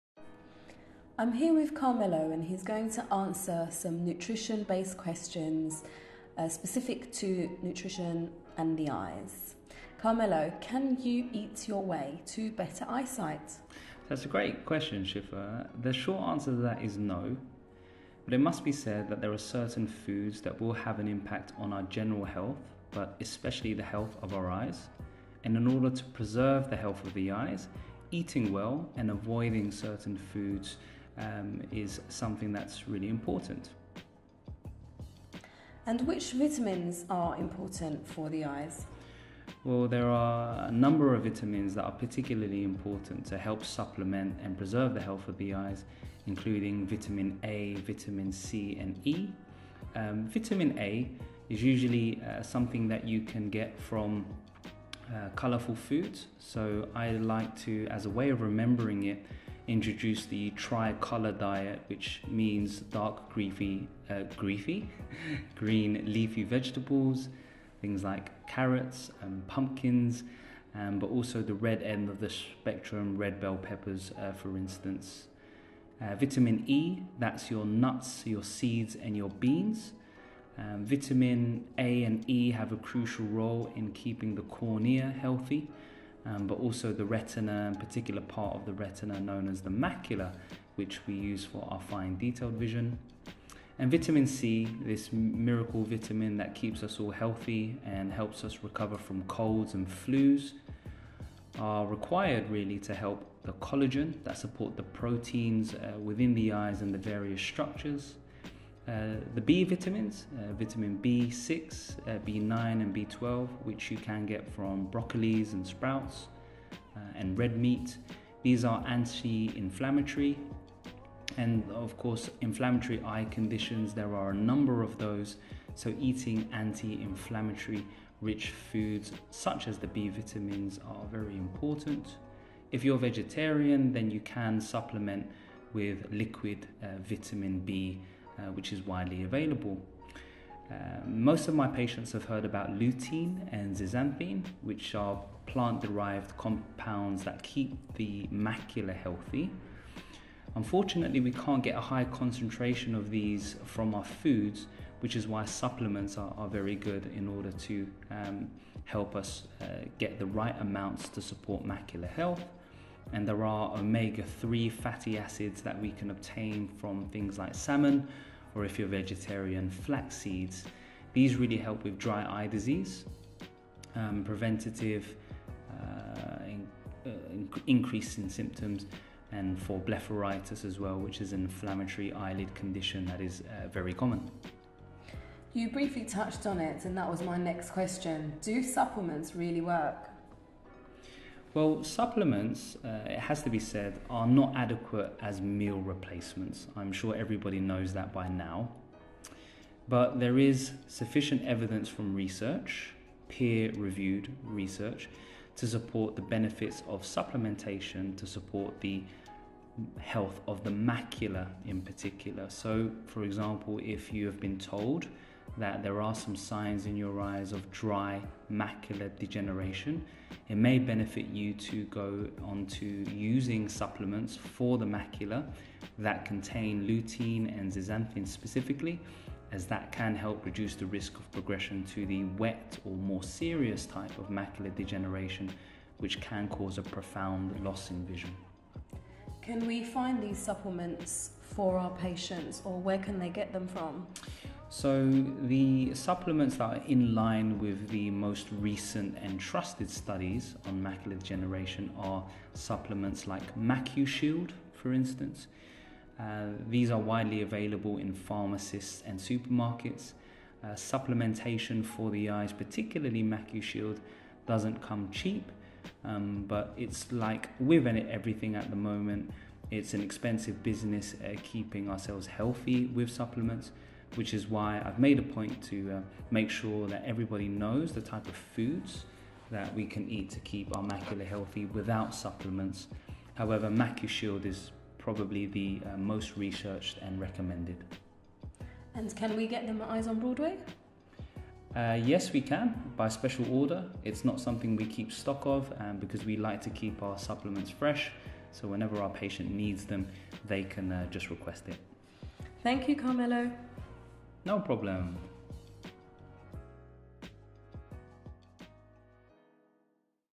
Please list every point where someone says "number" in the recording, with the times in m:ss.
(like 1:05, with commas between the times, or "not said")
0:40, 2:04.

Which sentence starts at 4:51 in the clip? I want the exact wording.
Uh, yes, we can by special order.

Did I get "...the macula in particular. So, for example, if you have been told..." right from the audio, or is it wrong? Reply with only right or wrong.
right.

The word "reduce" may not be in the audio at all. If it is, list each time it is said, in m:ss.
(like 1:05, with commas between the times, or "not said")
3:50.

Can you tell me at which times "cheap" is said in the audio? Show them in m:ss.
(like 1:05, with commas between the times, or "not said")
4:25.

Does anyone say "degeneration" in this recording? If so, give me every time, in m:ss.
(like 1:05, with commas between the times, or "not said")
3:39, 3:54, 4:11.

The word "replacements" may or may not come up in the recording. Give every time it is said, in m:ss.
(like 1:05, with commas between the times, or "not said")
3:15.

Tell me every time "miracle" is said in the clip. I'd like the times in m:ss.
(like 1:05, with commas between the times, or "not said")
1:35.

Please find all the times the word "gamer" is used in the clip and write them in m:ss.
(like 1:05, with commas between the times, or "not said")
not said.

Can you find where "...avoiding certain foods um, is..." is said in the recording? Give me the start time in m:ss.
0:29.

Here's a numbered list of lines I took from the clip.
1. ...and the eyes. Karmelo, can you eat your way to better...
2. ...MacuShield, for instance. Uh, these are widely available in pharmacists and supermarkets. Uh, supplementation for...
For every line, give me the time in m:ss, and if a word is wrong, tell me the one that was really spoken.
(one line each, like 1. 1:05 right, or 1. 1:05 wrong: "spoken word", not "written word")
1. 0:08 right
2. 4:13 right.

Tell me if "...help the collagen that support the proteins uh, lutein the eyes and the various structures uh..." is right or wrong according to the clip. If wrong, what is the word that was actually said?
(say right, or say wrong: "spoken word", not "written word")
wrong: "within", not "lutein".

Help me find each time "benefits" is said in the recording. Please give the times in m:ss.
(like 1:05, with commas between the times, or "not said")
3:26, 3:40.